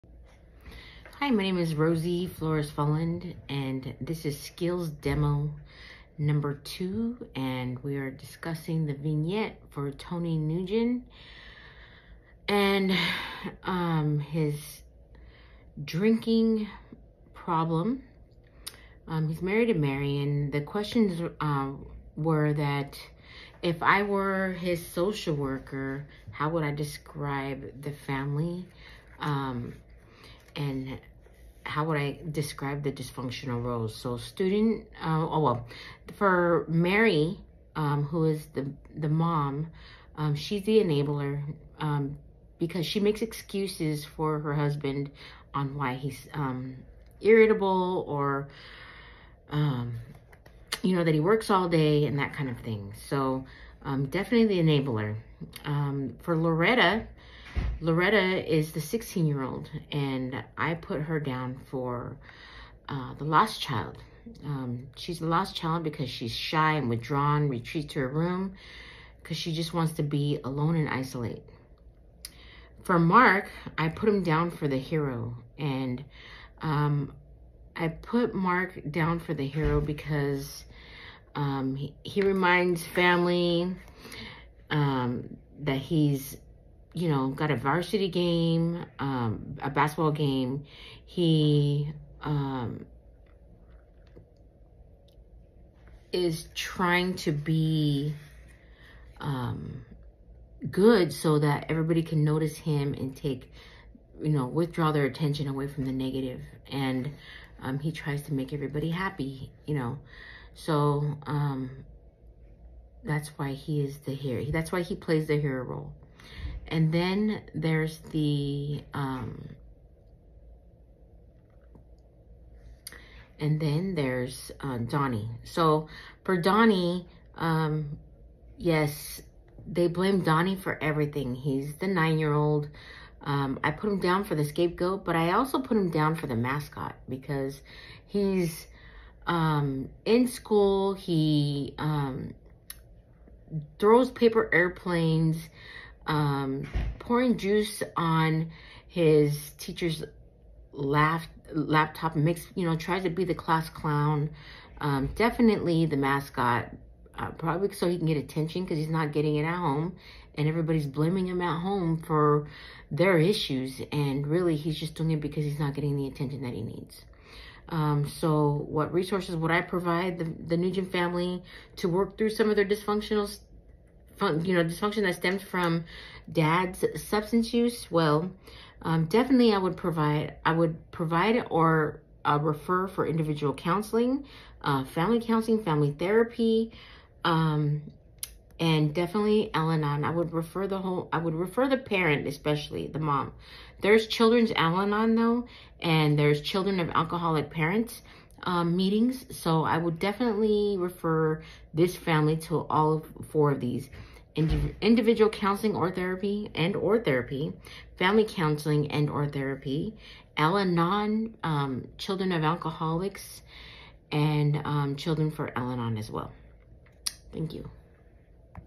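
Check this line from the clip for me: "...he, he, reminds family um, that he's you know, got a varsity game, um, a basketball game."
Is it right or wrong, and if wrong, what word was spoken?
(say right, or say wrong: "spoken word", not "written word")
right.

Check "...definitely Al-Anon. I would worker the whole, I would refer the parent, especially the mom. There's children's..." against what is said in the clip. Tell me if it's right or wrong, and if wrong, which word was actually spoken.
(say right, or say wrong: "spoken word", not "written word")
wrong: "refer", not "worker".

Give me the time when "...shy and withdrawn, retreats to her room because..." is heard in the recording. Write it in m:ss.
1:06.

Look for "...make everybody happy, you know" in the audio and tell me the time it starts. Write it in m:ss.
1:48.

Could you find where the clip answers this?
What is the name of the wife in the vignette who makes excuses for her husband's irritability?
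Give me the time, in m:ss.
0:19.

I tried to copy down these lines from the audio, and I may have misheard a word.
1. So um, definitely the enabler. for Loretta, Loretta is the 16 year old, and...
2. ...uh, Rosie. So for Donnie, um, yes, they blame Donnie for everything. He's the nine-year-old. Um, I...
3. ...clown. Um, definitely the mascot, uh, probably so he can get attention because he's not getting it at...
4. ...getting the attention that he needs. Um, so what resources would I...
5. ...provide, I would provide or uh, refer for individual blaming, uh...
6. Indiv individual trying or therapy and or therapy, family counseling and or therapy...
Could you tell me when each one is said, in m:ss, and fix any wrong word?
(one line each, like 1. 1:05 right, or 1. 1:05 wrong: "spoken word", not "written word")
1. 0:53 right
2. 2:04 wrong: "Donnie", not "Rosie"
3. 2:33 right
4. 2:45 right
5. 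2:59 wrong: "counseling", not "blaming"
6. 3:24 wrong: "counseling", not "trying".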